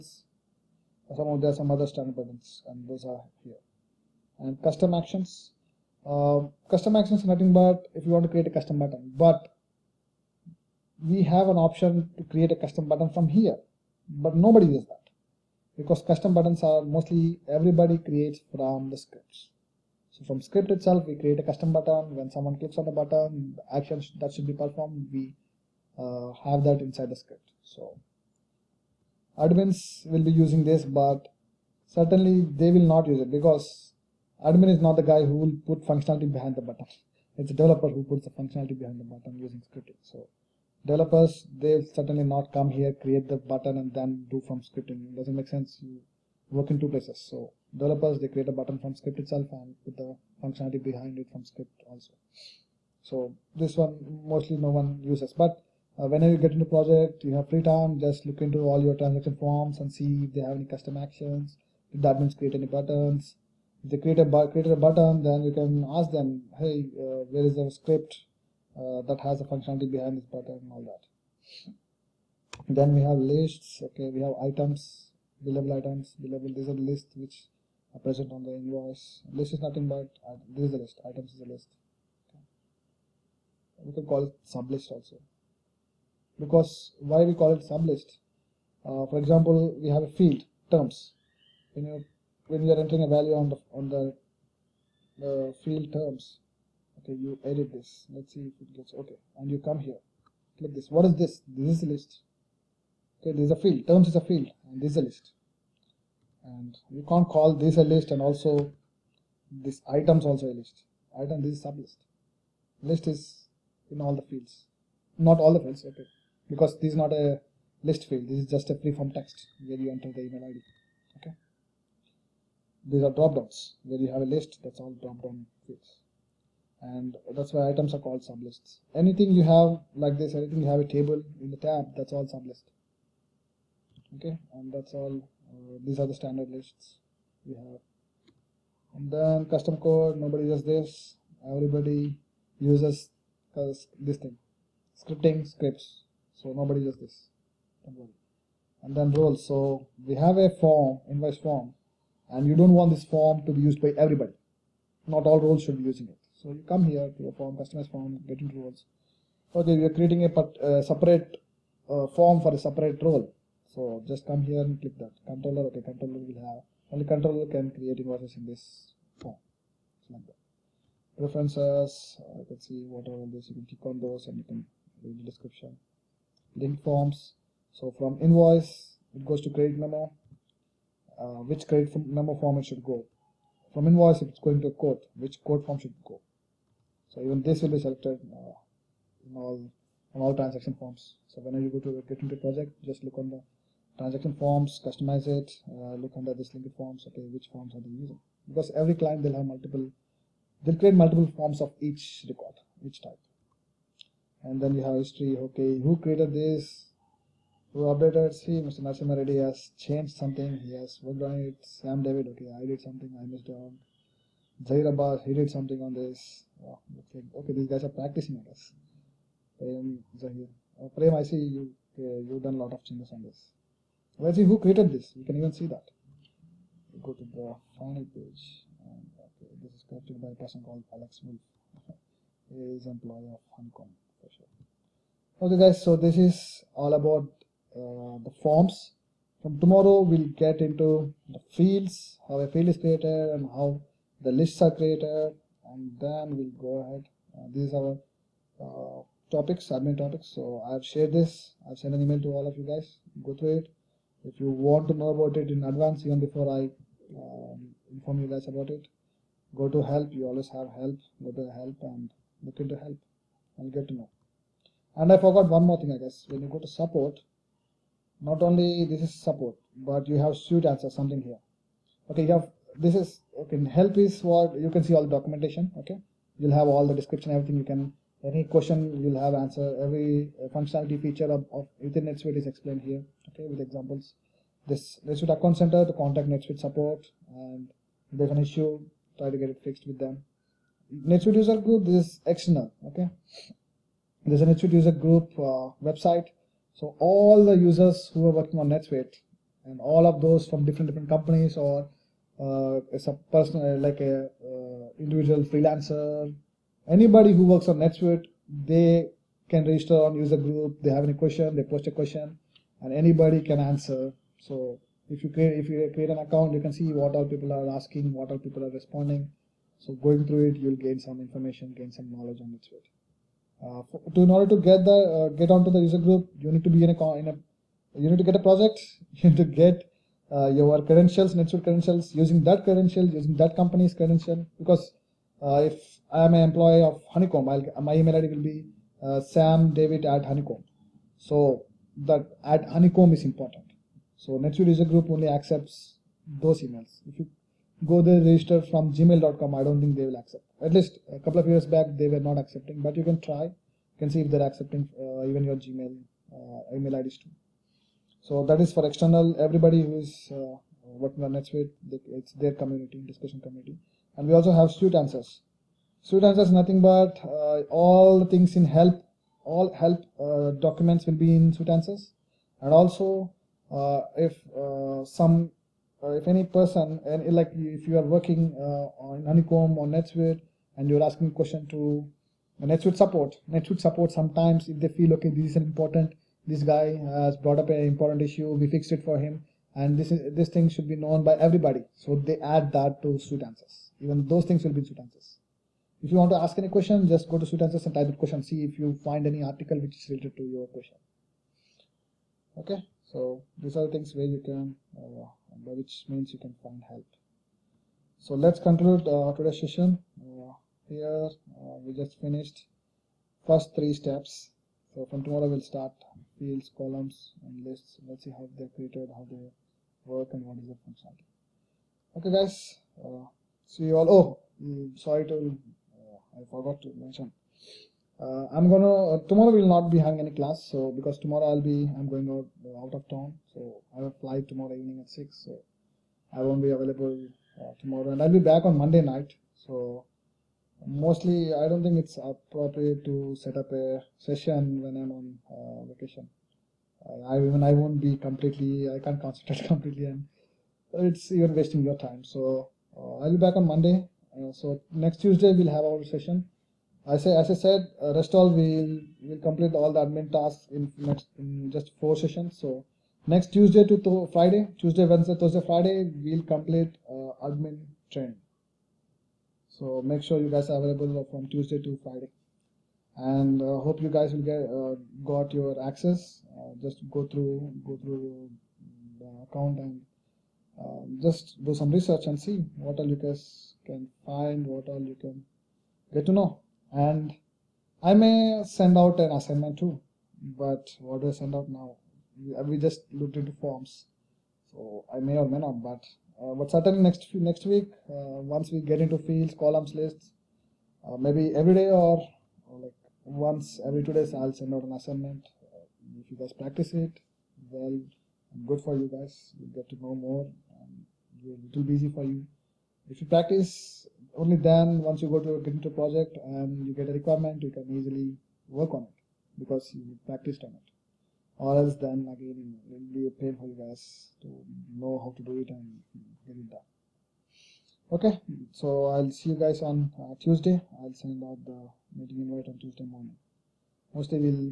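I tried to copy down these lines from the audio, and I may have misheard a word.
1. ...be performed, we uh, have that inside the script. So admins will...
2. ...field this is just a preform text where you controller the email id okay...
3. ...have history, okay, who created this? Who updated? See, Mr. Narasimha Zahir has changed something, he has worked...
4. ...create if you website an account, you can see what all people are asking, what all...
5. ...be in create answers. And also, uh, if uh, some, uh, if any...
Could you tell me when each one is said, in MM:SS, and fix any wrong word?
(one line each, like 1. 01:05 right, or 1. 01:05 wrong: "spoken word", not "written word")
1. 00:24 right
2. 01:58 wrong: "enter", not "controller"
3. 03:24 wrong: "Reddy", not "Zahir"
4. 05:15 wrong: "create", not "website"
5. 06:11 wrong: "suite", not "create".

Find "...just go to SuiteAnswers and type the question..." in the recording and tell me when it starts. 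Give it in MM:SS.
06:37.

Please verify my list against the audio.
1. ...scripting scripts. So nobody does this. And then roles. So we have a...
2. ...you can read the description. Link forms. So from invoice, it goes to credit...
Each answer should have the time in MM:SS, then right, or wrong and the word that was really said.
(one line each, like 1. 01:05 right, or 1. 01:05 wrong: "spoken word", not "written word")
1. 02:24 right
2. 02:54 right.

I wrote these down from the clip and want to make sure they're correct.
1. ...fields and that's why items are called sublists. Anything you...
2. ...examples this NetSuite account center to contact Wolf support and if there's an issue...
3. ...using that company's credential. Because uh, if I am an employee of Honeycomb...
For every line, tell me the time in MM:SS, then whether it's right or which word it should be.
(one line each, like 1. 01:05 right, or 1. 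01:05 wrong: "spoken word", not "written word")
1. 02:05 right
2. 04:43 wrong: "NetSuite", not "Wolf"
3. 05:33 right.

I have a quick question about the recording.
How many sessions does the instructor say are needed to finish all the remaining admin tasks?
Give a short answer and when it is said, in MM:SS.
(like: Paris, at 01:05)
4, at 07:41.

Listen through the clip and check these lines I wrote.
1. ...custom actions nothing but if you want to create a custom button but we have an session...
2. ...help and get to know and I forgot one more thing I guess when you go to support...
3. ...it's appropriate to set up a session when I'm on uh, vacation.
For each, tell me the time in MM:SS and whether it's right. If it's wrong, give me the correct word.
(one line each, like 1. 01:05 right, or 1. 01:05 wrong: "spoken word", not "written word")
1. 00:06 wrong: "option", not "session"
2. 04:22 right
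3. 07:21 right.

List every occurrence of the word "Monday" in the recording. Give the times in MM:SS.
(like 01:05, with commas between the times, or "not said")
07:18, 07:33.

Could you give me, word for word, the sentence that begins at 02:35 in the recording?
Not all roles should be using it.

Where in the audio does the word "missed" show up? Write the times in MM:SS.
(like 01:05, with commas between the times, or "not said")
03:33.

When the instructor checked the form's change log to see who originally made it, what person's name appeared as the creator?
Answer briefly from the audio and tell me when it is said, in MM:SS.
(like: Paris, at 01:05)
Alex Wolf, at 03:50.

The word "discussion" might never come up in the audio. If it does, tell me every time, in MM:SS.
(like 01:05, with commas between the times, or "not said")
06:03.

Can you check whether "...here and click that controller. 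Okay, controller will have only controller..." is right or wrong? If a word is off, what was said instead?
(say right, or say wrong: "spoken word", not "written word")
right.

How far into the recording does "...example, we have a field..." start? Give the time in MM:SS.
01:29.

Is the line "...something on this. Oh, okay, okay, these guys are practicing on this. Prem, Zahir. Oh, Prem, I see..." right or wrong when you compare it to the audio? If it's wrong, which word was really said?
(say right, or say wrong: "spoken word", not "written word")
right.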